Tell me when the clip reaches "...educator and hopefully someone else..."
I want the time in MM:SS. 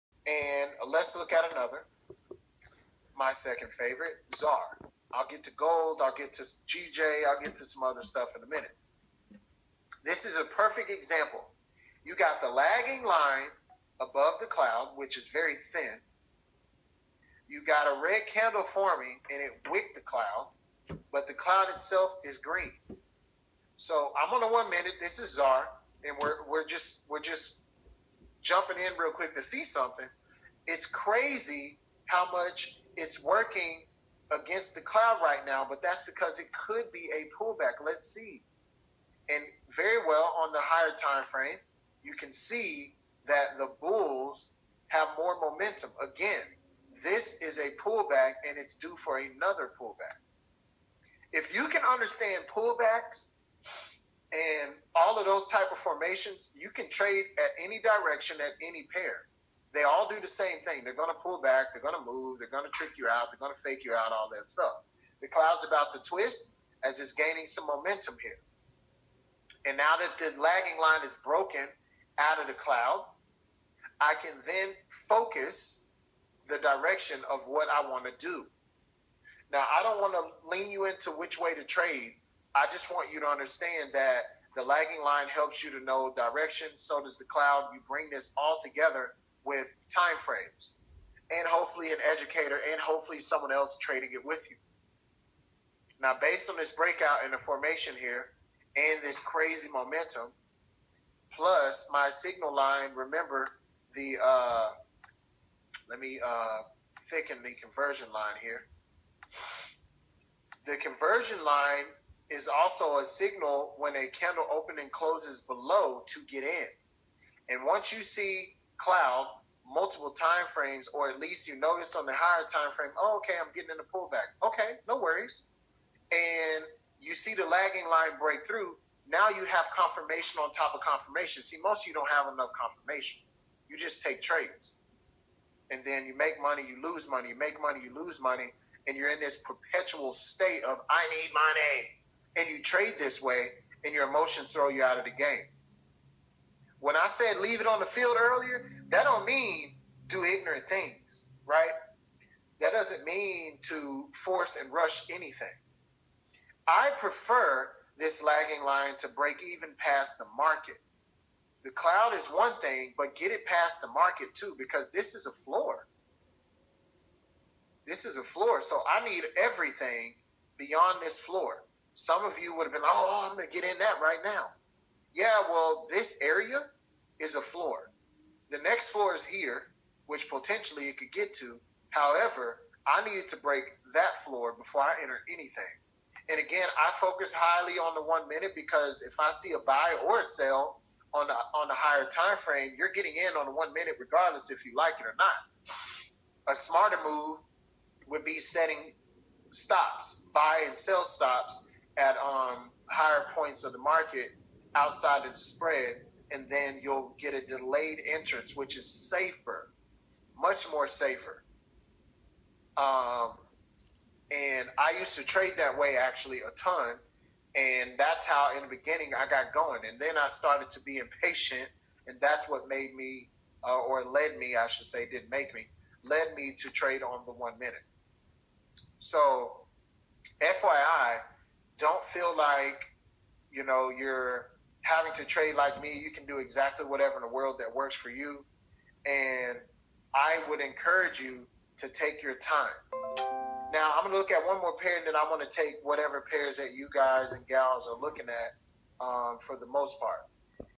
01:32.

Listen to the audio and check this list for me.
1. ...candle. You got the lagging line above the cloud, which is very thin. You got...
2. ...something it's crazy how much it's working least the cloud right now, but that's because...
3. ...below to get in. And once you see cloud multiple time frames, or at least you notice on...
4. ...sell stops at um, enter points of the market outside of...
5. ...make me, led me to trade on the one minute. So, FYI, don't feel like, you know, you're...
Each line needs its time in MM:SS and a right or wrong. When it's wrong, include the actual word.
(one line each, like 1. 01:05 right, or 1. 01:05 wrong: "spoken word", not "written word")
1. 00:10 wrong: "example", not "candle"
2. 00:29 wrong: "against", not "least"
3. 01:55 right
4. 03:20 wrong: "higher", not "enter"
5. 03:45 right.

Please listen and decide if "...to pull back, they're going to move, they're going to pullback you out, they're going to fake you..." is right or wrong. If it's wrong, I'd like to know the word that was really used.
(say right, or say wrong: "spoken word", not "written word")
wrong: "trick", not "pullback".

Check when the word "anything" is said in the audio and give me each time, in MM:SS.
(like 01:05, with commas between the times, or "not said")
02:35, 03:05.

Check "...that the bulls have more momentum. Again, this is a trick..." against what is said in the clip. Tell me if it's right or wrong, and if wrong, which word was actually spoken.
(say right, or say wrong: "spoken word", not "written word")
wrong: "pullback", not "trick".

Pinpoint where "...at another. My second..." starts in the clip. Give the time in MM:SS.
00:01.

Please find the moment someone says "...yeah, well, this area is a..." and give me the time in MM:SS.
02:55.